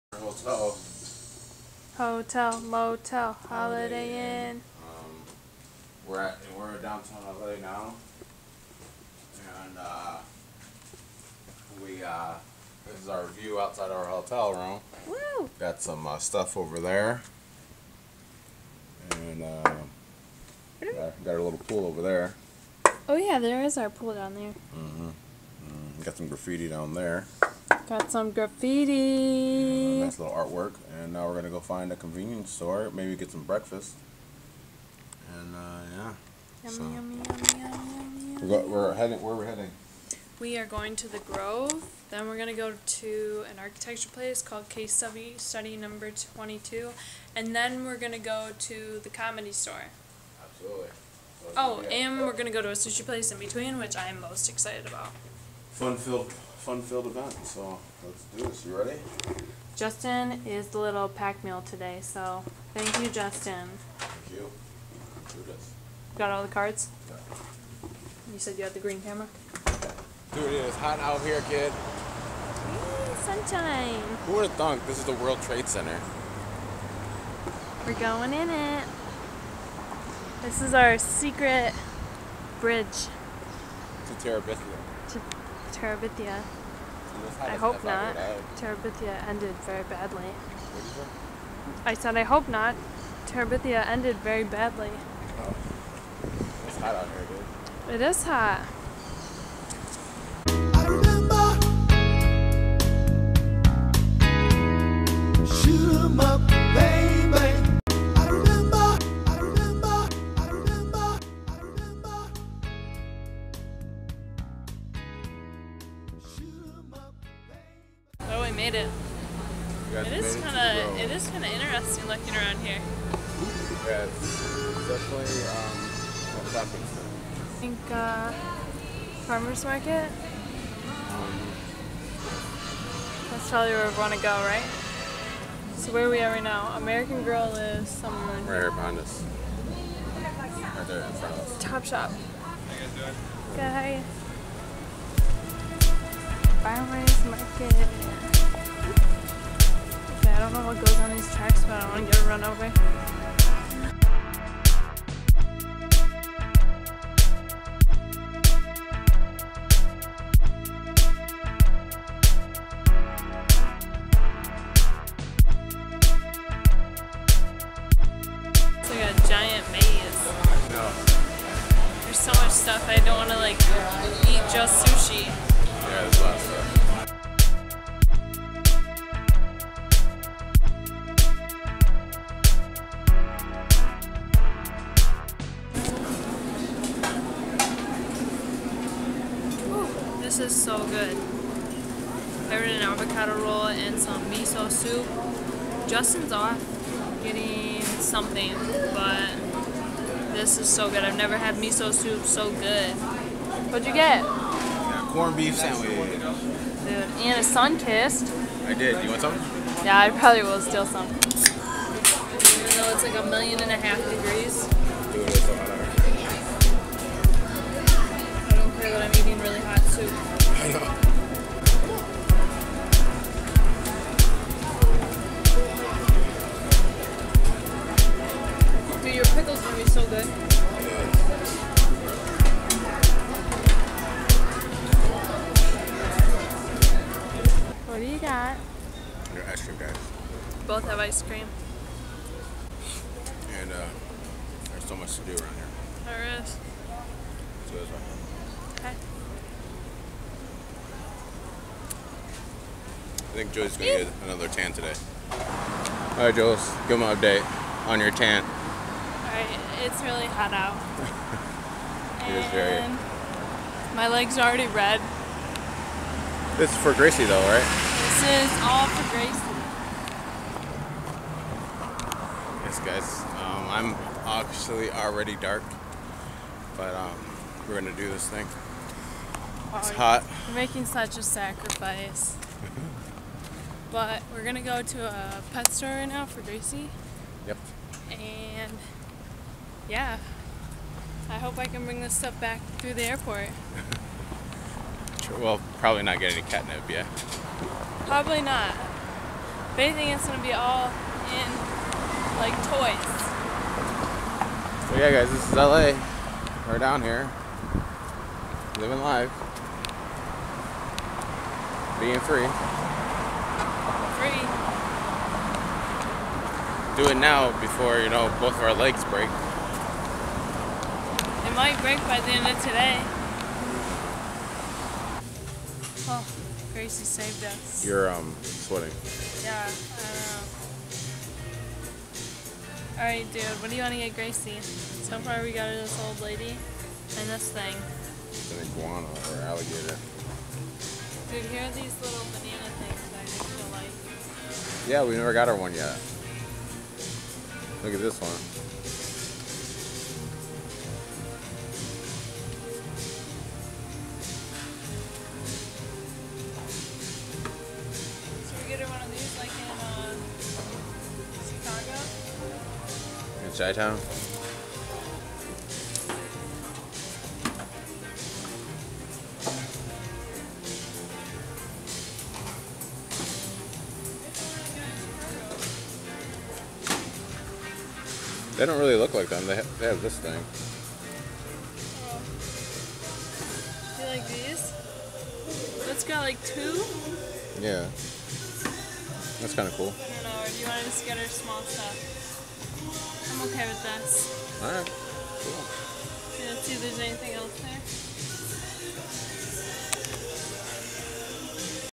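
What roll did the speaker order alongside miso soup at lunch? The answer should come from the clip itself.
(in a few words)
avocado roll.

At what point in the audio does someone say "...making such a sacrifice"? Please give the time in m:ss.
4:40.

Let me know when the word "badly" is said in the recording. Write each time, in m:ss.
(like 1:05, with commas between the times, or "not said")
1:29, 1:34.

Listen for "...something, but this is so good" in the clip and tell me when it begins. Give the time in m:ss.
3:17.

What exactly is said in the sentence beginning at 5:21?
It might break by the end of today.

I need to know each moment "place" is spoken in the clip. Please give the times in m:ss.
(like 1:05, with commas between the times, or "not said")
0:44, 0:53.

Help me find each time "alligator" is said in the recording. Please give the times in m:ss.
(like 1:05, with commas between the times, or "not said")
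5:39.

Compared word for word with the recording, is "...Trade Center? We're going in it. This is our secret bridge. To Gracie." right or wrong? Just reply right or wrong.
wrong.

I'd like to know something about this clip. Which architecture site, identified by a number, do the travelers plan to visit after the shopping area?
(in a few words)
Case Study 22.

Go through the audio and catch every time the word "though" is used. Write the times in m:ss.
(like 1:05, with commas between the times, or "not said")
3:31, 4:27.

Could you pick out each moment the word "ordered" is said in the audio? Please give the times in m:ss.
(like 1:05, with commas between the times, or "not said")
3:12.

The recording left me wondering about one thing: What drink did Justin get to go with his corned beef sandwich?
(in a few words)
Sunkist.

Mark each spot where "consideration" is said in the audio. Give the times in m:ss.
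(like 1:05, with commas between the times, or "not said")
not said.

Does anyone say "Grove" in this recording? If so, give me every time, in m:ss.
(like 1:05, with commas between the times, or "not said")
0:41.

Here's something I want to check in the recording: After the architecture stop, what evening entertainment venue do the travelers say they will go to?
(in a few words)
The Comedy Store.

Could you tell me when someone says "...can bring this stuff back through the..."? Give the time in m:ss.
4:51.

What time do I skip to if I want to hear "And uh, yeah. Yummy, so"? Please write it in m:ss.
0:35.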